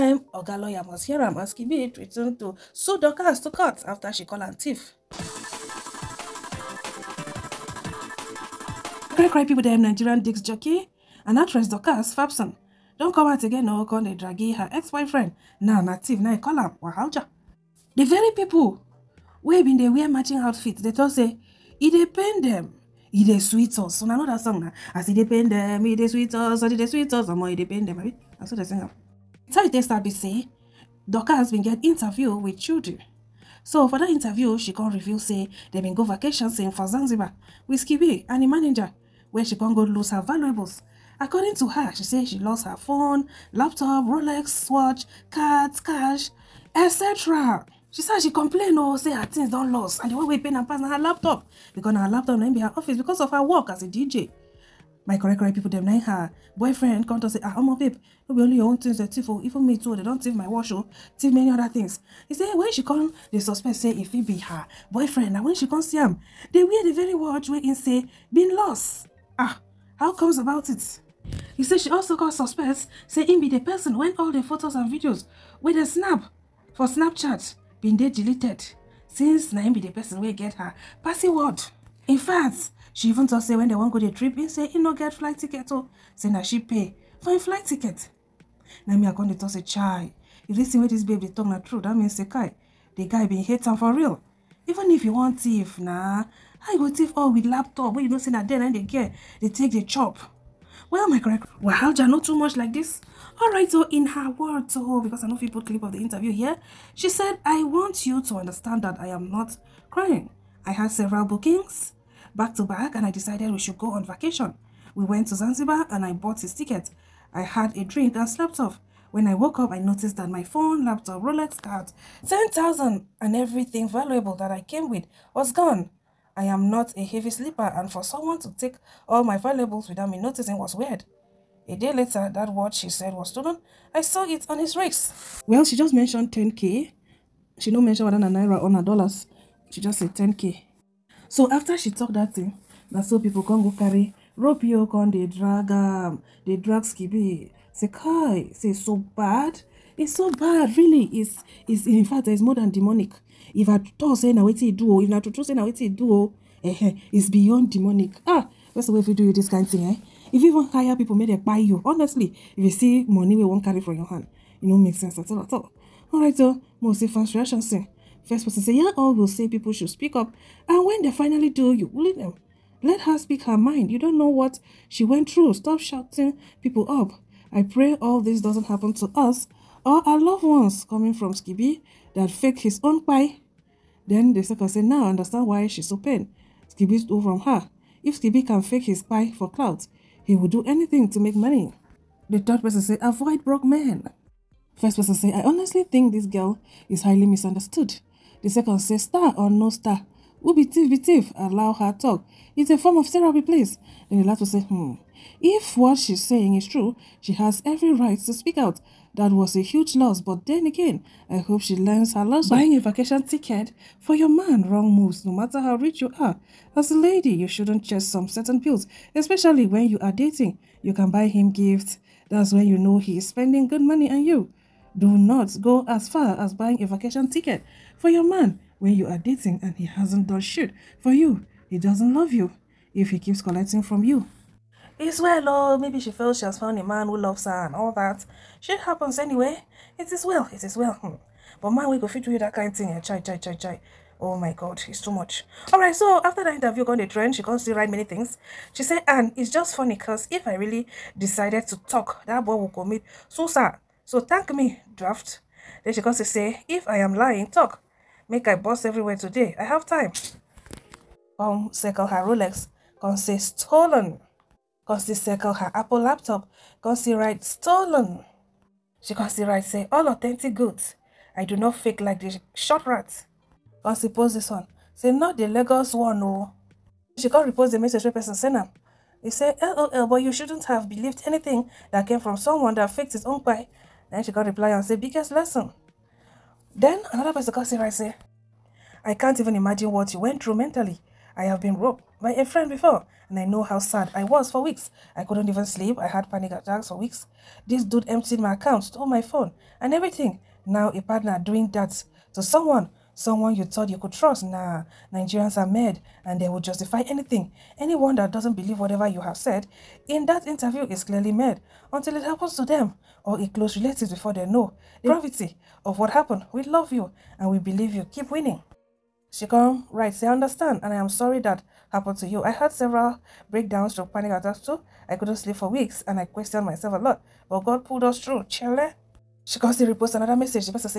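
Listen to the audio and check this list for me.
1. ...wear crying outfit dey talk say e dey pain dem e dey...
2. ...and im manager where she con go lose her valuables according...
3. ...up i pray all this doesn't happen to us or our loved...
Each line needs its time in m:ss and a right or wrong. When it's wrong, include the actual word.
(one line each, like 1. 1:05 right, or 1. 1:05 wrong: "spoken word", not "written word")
1. 0:19 wrong: "matching", not "crying"
2. 0:38 right
3. 2:56 right.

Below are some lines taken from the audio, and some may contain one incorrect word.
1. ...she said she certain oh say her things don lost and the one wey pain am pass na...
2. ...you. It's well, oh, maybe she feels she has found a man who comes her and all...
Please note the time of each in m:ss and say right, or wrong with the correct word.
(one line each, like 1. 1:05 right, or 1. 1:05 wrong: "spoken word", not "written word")
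1. 0:47 wrong: "complain", not "certain"
2. 3:54 wrong: "loves", not "comes".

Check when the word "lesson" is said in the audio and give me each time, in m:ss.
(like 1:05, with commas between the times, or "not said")
3:32, 4:45.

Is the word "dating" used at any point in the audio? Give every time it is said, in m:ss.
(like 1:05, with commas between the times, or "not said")
3:40, 3:49.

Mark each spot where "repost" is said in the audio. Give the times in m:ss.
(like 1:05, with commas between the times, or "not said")
4:37, 5:29.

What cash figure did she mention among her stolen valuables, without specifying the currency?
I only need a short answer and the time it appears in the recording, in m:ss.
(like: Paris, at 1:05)
10,000, at 2:02.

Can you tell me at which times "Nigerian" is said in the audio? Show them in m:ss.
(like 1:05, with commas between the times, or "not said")
0:09, 5:05.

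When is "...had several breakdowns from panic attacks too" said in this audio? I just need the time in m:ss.
5:22.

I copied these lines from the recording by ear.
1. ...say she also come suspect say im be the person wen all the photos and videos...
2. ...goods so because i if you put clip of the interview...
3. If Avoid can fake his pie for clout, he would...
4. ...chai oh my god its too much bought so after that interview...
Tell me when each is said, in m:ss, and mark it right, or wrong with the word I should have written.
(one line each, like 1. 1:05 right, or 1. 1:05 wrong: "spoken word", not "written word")
1. 1:11 right
2. 1:44 wrong: "words", not "goods"
3. 3:08 wrong: "Skiibii", not "Avoid"
4. 4:03 wrong: "alright", not "bought".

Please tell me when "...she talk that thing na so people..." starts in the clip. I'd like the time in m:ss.
2:21.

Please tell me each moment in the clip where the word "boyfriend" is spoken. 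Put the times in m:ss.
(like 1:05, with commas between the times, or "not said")
0:14, 0:56, 1:04.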